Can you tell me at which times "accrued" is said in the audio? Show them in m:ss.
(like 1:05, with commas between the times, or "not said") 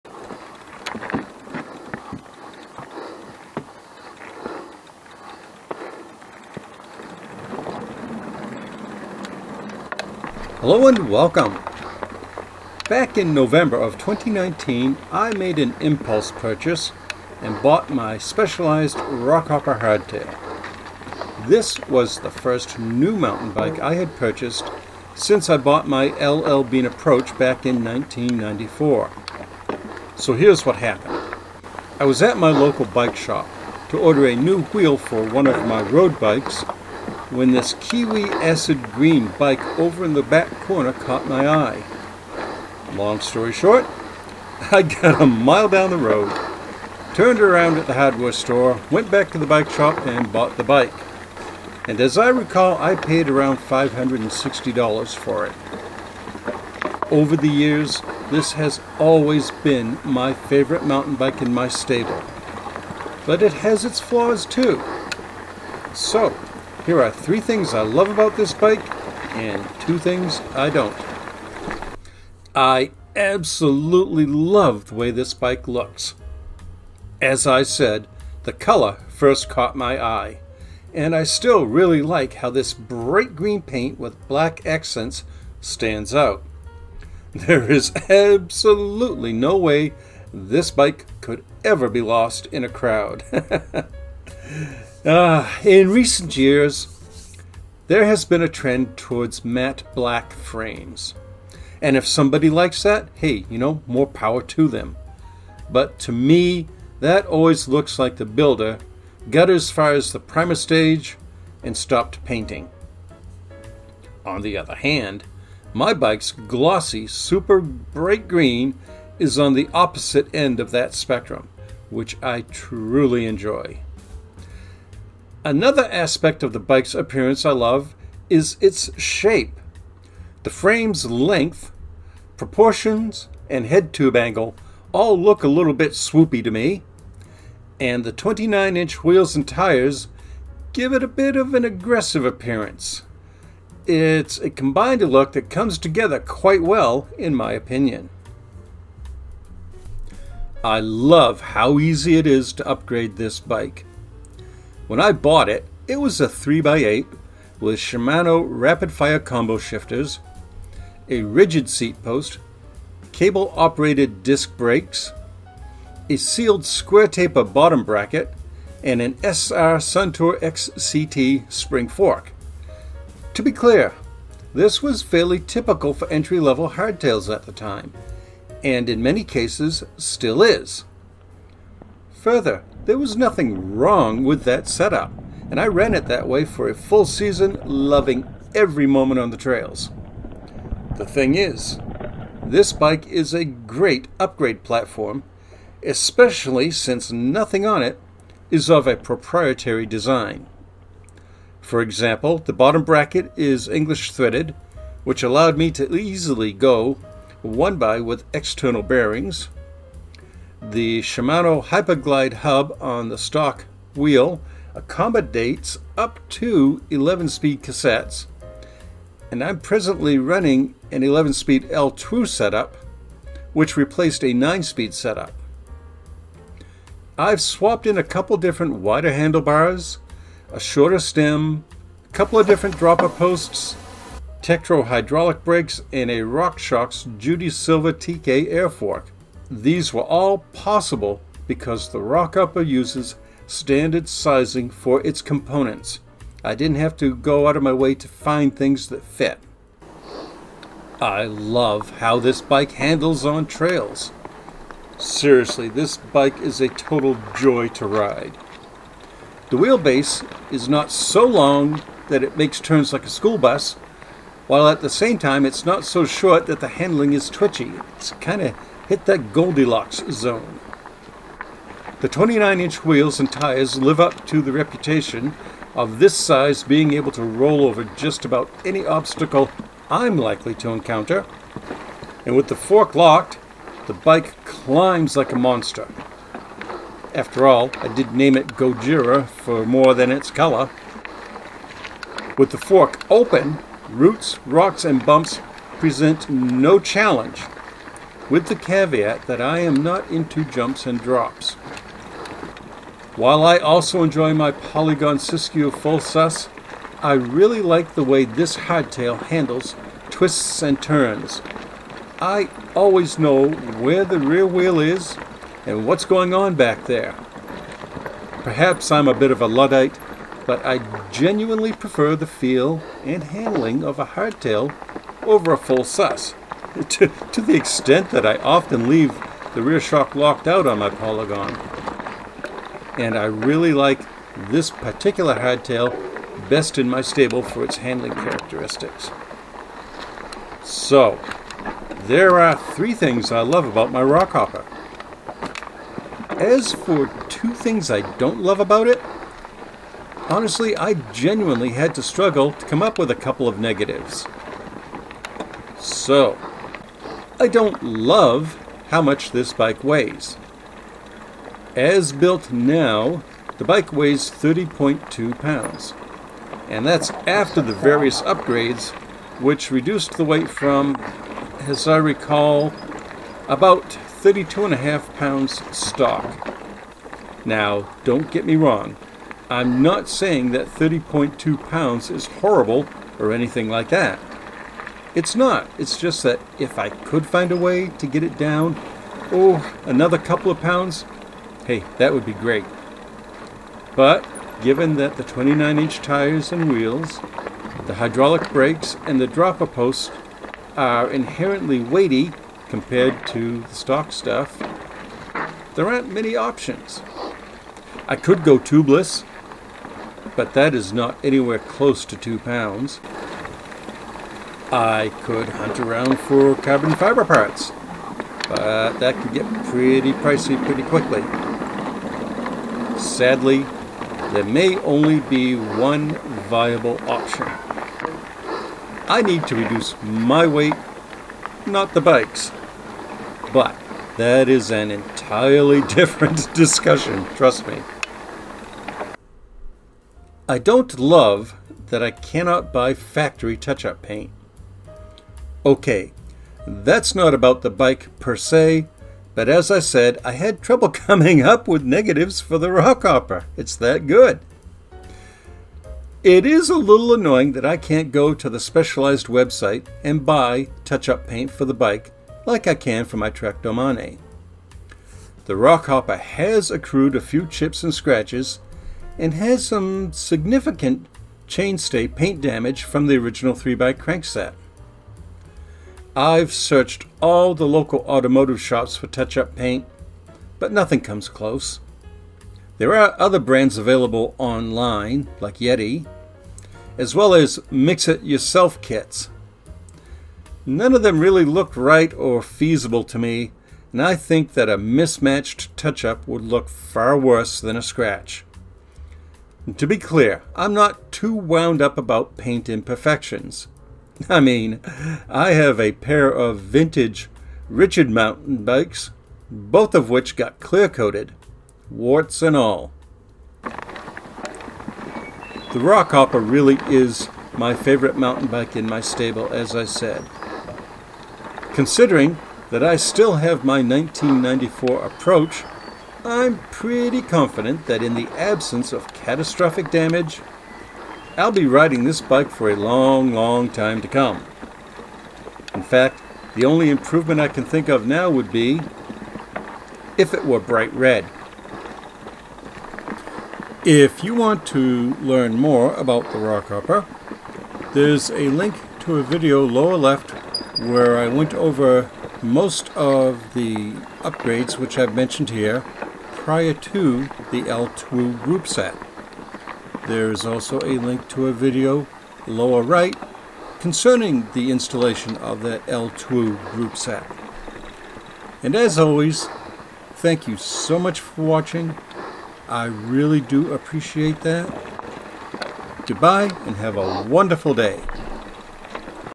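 7:46.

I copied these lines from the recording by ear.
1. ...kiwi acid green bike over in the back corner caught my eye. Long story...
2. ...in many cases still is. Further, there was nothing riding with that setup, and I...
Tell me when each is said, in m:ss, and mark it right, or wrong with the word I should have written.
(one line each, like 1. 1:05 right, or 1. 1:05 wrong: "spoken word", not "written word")
1. 0:37 right
2. 2:58 wrong: "wrong", not "riding".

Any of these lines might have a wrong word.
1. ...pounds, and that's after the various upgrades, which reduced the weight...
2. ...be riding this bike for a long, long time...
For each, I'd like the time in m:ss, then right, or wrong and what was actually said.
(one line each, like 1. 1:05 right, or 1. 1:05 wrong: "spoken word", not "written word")
1. 6:05 right
2. 8:51 right.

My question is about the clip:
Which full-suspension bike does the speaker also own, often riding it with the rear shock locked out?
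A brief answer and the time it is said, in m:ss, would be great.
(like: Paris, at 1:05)
Polygon Siskiu, at 5:04.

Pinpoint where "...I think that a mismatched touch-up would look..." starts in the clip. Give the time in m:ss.
8:14.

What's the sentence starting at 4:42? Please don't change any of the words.
And with the fork locked, the bike climbs like a monster.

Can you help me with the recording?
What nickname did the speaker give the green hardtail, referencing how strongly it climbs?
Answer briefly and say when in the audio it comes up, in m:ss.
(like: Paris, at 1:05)
Gojira, at 4:48.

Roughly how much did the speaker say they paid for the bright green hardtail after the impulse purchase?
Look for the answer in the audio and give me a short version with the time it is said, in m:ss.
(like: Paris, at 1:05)
$560, at 0:53.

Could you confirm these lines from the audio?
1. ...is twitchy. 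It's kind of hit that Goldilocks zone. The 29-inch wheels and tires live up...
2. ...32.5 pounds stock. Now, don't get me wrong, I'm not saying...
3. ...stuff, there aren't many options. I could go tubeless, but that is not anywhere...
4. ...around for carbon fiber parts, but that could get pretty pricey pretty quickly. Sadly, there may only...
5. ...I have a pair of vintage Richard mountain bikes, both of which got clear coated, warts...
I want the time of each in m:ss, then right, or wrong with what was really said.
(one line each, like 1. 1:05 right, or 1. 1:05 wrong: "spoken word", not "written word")
1. 4:27 right
2. 6:14 right
3. 6:44 right
4. 6:55 right
5. 8:25 right.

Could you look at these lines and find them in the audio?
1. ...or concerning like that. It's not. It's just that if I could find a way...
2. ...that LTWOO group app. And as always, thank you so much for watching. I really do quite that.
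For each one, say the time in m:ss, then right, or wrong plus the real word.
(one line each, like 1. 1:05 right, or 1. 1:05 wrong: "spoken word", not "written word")
1. 6:23 wrong: "anything", not "concerning"
2. 9:25 wrong: "appreciate", not "quite".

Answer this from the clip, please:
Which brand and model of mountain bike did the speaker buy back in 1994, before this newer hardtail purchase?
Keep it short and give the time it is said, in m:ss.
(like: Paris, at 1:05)
LL Bean Approach, at 0:26.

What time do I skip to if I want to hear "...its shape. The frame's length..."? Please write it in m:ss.
2:08.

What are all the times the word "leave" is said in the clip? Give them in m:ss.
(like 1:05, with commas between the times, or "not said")
5:28.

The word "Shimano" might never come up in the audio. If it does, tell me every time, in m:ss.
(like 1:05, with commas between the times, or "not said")
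2:37, 3:31.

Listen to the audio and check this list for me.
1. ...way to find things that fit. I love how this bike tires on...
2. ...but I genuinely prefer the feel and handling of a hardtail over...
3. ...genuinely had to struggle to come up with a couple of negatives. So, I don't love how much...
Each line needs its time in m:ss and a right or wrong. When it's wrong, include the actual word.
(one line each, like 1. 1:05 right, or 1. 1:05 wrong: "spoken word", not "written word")
1. 4:07 wrong: "handles", not "tires"
2. 5:20 right
3. 5:51 right.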